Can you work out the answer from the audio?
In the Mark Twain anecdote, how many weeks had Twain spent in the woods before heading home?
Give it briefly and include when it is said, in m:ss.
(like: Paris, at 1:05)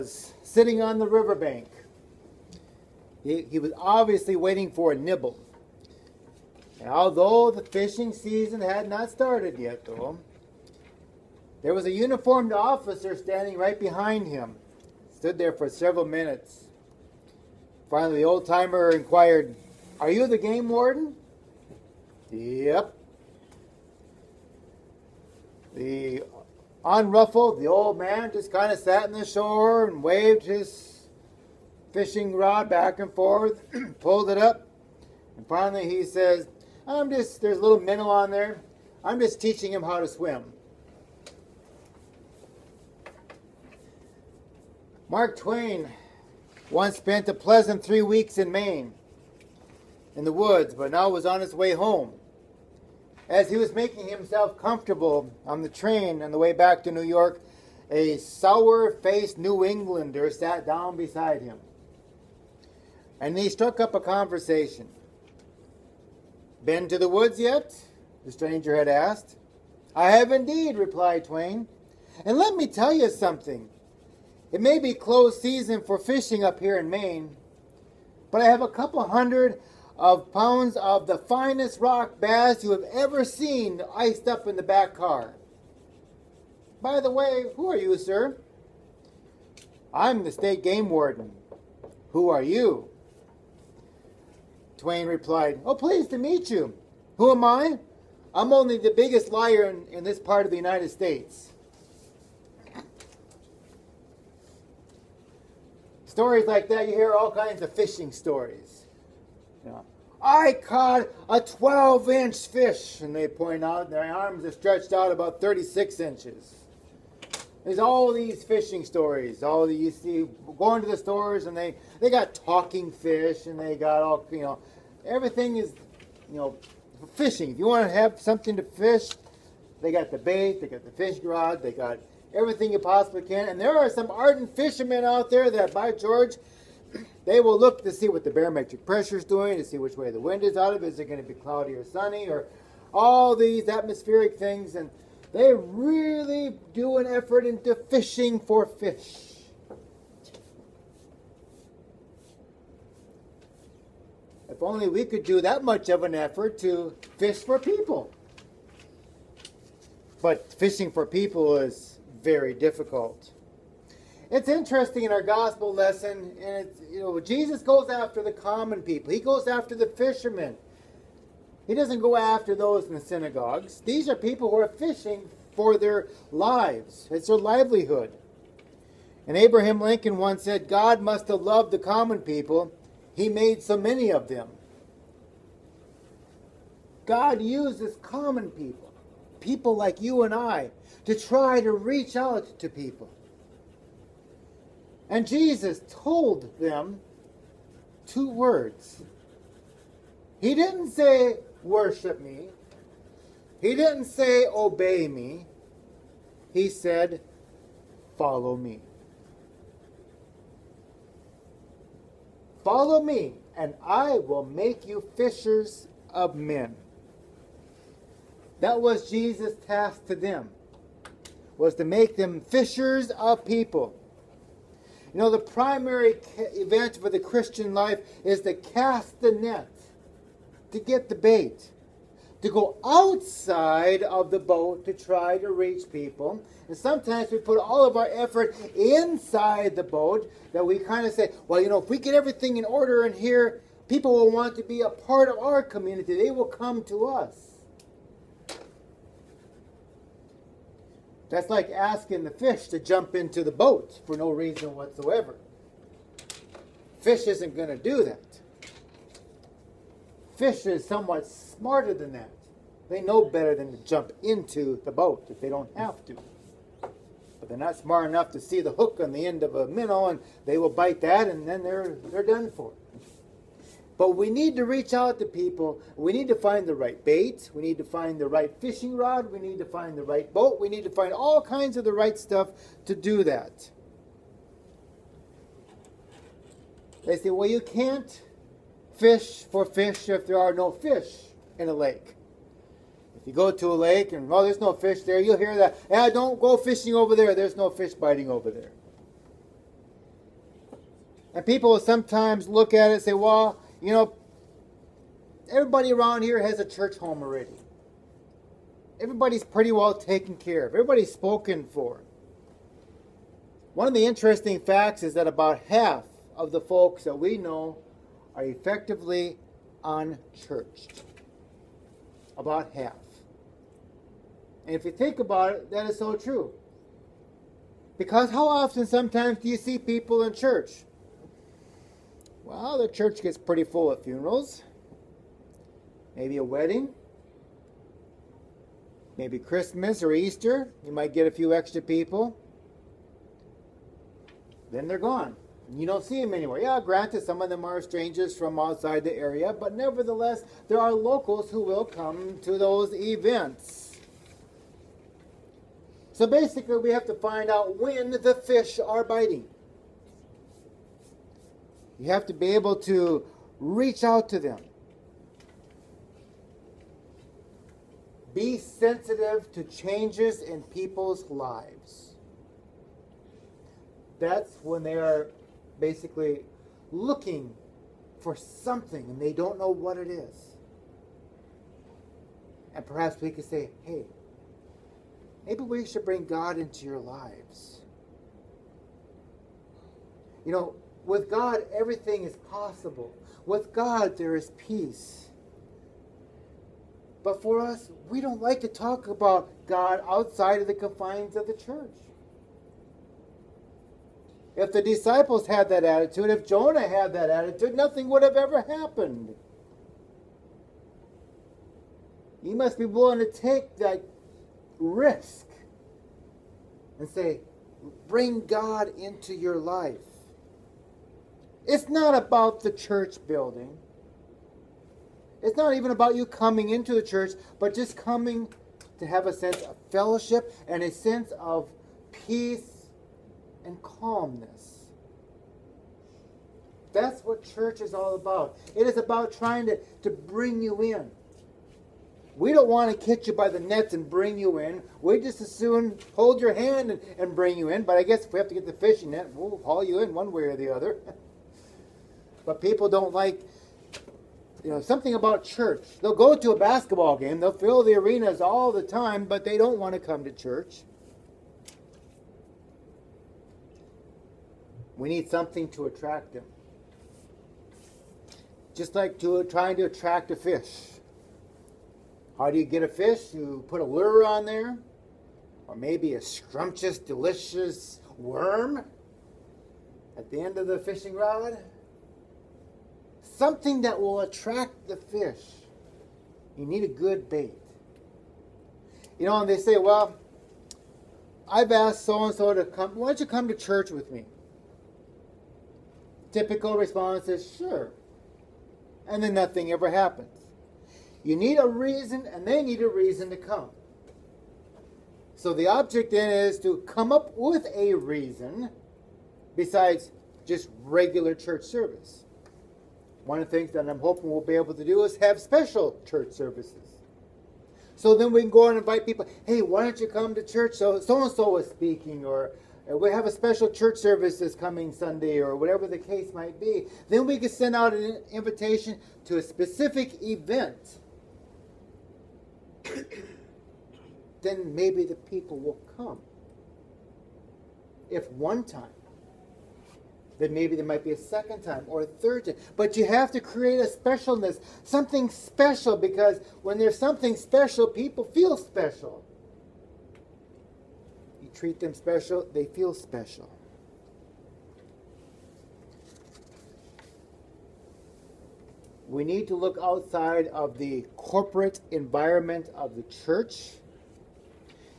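3, at 0:47.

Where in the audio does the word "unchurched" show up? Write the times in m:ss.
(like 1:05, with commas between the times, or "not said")
5:19.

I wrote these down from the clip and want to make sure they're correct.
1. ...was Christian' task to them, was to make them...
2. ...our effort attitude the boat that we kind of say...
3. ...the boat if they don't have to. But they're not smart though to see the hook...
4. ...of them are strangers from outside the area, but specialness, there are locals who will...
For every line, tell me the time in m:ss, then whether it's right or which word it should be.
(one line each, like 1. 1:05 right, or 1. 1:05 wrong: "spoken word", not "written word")
1. 3:38 wrong: "Jesus", not "Christian"
2. 3:57 wrong: "inside", not "attitude"
3. 4:24 wrong: "enough", not "though"
4. 5:47 wrong: "nevertheless", not "specialness".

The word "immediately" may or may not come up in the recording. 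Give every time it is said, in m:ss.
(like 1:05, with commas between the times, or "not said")
not said.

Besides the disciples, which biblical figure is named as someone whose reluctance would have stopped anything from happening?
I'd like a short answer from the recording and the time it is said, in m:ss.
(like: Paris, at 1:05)
Jonah, at 6:46.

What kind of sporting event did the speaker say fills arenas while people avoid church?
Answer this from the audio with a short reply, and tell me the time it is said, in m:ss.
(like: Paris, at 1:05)
basketball game, at 7:36.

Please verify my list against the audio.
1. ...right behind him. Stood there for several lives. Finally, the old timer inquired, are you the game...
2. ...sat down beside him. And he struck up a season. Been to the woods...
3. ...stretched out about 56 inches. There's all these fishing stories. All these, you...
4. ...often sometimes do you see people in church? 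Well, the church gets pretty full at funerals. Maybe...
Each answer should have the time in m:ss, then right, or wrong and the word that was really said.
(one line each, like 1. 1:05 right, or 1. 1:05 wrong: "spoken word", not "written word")
1. 0:13 wrong: "minutes", not "lives"
2. 1:00 wrong: "conversation", not "season"
3. 1:54 wrong: "36", not "56"
4. 5:28 right.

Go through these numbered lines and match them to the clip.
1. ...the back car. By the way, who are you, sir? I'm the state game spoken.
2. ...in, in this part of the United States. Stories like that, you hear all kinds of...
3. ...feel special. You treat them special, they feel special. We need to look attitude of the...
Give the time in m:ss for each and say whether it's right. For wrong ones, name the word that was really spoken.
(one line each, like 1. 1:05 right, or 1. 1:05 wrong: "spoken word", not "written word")
1. 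1:24 wrong: "warden", not "spoken"
2. 1:39 right
3. 9:08 wrong: "outside", not "attitude".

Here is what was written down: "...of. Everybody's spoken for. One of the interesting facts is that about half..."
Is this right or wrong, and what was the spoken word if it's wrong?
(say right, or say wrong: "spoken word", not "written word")
right.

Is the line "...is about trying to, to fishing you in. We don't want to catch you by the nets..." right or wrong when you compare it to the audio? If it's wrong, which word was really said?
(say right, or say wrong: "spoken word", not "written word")
wrong: "bring", not "fishing".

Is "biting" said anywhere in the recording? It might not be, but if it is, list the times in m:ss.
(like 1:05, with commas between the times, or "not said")
4:57, 5:59.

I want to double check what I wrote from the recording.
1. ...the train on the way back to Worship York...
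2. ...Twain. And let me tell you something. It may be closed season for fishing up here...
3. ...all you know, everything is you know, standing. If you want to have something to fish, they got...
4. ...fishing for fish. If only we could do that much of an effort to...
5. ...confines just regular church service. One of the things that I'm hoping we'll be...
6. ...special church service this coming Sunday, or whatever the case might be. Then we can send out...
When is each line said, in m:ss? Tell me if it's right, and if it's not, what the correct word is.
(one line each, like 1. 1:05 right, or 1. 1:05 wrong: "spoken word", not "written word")
1. 0:55 wrong: "New", not "Worship"
2. 1:11 right
3. 2:04 wrong: "fishing", not "standing"
4. 2:27 right
5. 8:29 wrong: "besides", not "confines"
6. 8:43 right.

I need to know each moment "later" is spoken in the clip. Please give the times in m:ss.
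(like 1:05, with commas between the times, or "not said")
not said.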